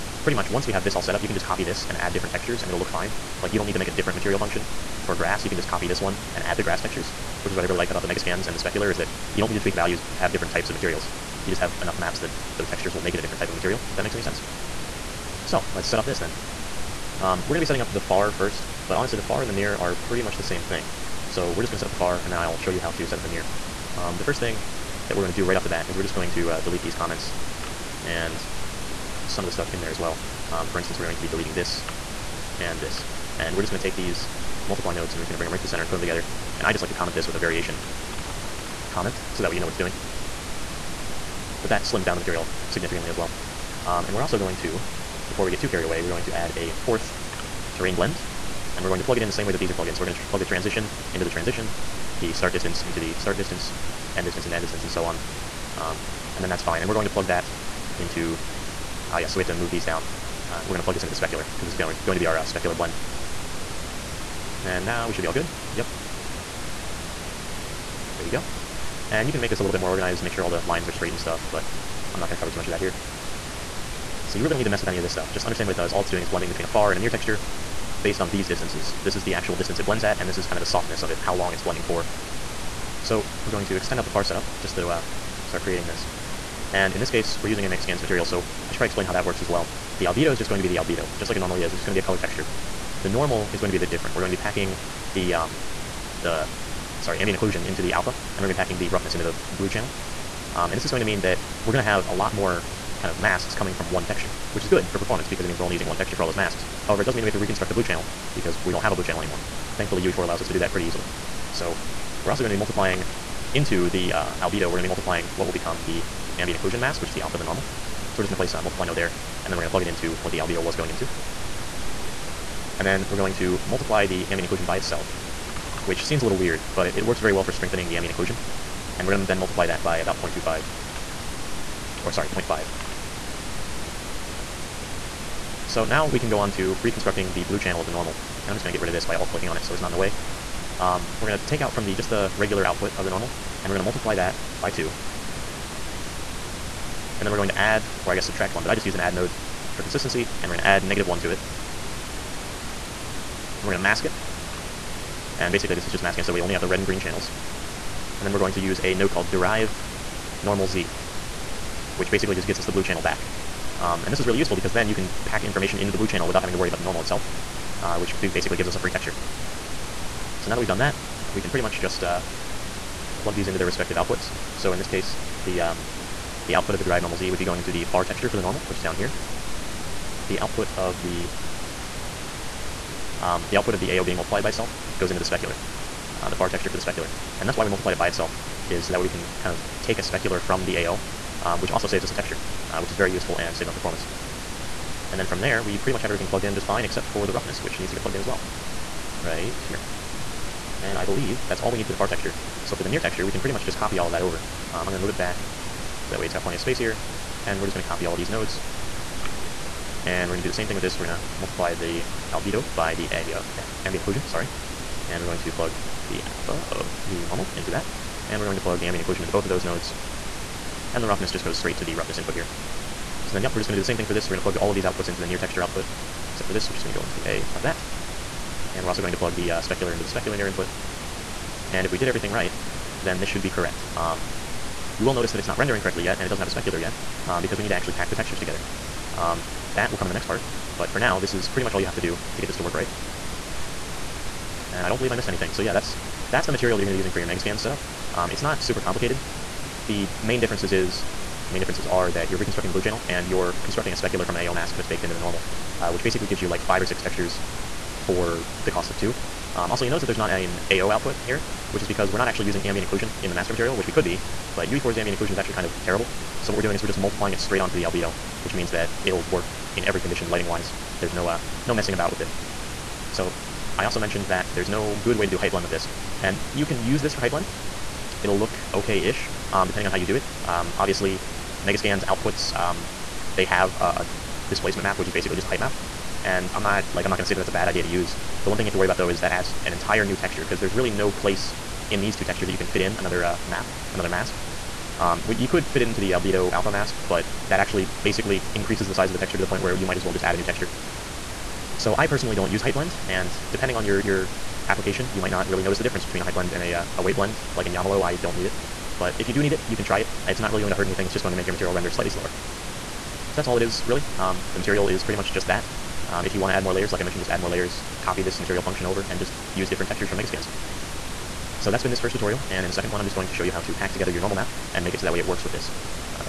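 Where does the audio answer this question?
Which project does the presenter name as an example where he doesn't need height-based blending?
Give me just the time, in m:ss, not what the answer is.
5:07.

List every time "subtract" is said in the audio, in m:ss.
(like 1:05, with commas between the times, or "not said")
2:28.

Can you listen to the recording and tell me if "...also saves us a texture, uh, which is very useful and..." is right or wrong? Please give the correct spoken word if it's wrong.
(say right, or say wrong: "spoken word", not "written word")
right.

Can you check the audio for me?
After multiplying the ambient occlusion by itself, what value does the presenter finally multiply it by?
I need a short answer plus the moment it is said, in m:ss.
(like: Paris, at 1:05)
0.5, at 2:12.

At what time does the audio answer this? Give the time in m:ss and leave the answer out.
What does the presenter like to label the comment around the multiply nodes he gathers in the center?
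0:37.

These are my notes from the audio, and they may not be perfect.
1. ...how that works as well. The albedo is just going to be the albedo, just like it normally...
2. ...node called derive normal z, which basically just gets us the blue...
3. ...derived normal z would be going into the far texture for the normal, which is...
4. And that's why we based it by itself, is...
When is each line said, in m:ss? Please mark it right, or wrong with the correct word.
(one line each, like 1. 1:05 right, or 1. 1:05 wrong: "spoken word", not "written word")
1. 1:29 right
2. 2:38 right
3. 2:56 right
4. 3:07 wrong: "multiplied", not "based".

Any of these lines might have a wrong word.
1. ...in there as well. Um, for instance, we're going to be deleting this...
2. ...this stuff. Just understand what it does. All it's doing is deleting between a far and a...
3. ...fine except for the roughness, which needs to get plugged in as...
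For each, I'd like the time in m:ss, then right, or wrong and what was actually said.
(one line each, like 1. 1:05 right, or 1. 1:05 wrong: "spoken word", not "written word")
1. 0:29 right
2. 1:15 wrong: "blending", not "deleting"
3. 3:16 right.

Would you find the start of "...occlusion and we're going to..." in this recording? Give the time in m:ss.
2:08.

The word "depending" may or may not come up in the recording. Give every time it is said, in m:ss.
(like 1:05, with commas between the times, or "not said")
4:39, 5:03.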